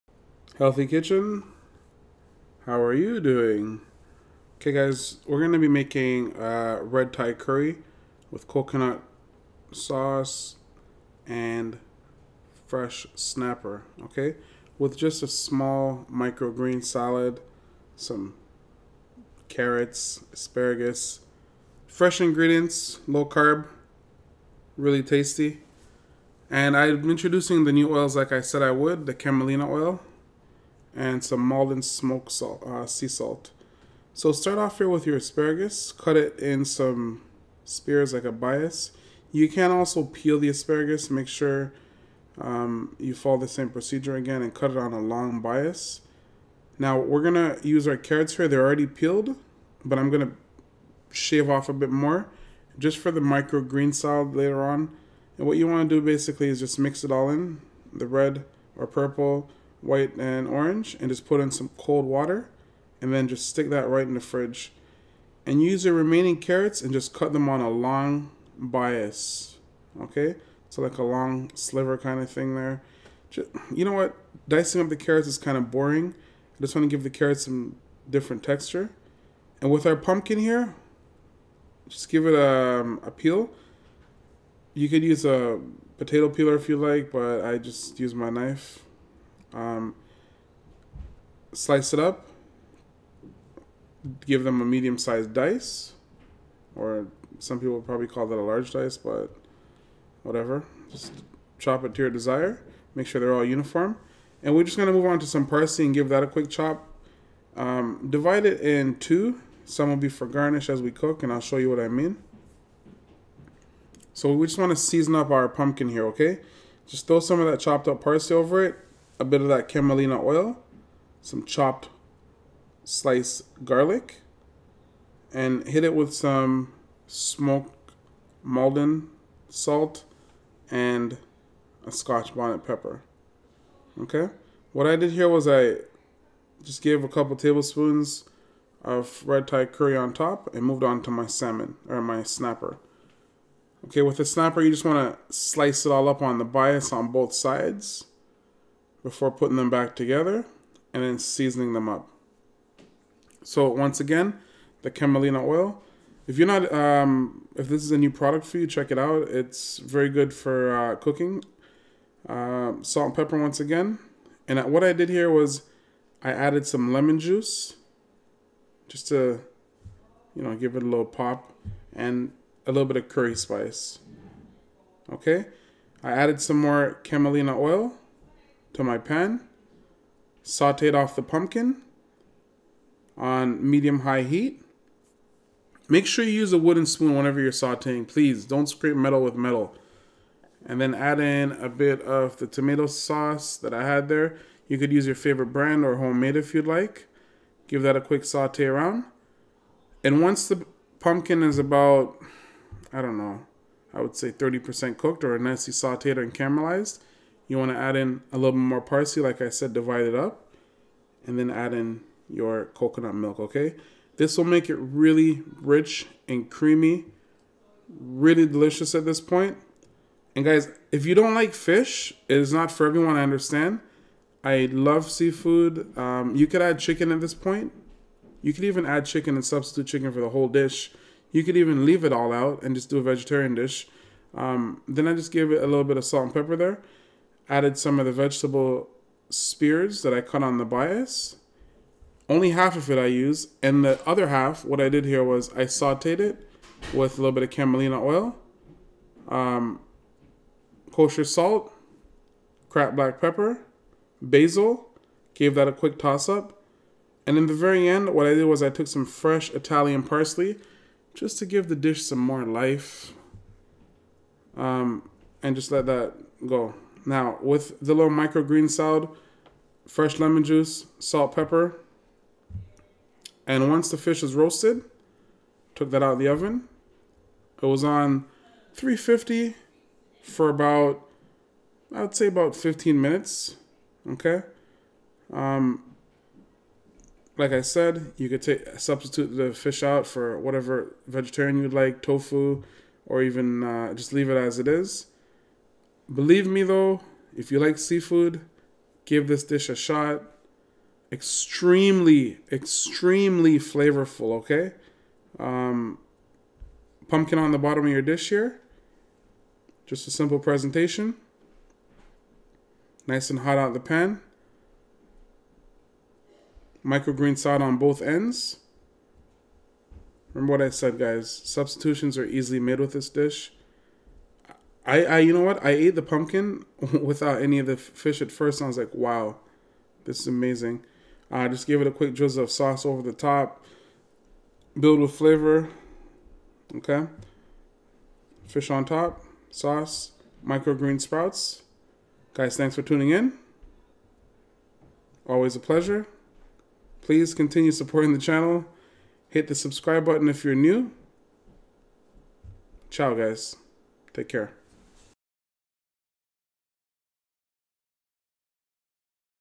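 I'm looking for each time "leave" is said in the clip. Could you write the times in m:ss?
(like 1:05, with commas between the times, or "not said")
3:51, 4:54.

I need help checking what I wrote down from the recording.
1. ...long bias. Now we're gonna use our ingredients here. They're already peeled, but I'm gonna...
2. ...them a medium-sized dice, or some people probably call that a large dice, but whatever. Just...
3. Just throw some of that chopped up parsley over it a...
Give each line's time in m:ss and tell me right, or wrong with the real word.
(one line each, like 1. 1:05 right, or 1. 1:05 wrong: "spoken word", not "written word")
1. 0:44 wrong: "carrots", not "ingredients"
2. 1:34 right
3. 1:56 right.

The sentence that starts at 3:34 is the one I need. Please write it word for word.
This will make it really rich and creamy, really delicious at this point.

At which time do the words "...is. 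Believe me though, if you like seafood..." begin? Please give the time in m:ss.
4:54.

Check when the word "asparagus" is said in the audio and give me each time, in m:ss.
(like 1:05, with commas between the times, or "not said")
0:20, 0:35, 0:40.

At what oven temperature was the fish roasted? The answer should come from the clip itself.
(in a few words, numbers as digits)
350.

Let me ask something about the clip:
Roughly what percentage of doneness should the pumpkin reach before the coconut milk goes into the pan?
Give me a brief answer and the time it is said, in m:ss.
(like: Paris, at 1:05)
30%, at 3:24.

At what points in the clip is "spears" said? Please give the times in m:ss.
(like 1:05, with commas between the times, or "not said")
0:37, 3:59.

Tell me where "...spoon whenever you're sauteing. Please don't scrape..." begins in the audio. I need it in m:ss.
3:06.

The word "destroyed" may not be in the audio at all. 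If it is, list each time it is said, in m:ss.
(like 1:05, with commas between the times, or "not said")
not said.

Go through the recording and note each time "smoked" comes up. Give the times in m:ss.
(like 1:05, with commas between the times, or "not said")
0:31, 2:07.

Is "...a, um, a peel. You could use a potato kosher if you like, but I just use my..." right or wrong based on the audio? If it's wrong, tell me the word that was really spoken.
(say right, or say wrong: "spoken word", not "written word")
wrong: "peeler", not "kosher".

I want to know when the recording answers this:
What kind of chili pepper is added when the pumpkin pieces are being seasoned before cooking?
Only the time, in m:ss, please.
2:11.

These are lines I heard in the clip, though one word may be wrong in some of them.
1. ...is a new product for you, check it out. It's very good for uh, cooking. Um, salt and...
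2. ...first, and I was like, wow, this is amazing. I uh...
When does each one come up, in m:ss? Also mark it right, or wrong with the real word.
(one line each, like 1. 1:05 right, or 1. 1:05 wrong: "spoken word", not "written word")
1. 2:37 right
2. 5:28 right.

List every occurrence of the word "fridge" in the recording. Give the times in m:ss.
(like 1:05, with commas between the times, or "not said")
1:04.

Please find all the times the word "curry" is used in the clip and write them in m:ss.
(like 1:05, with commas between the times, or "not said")
0:07, 2:19, 2:53.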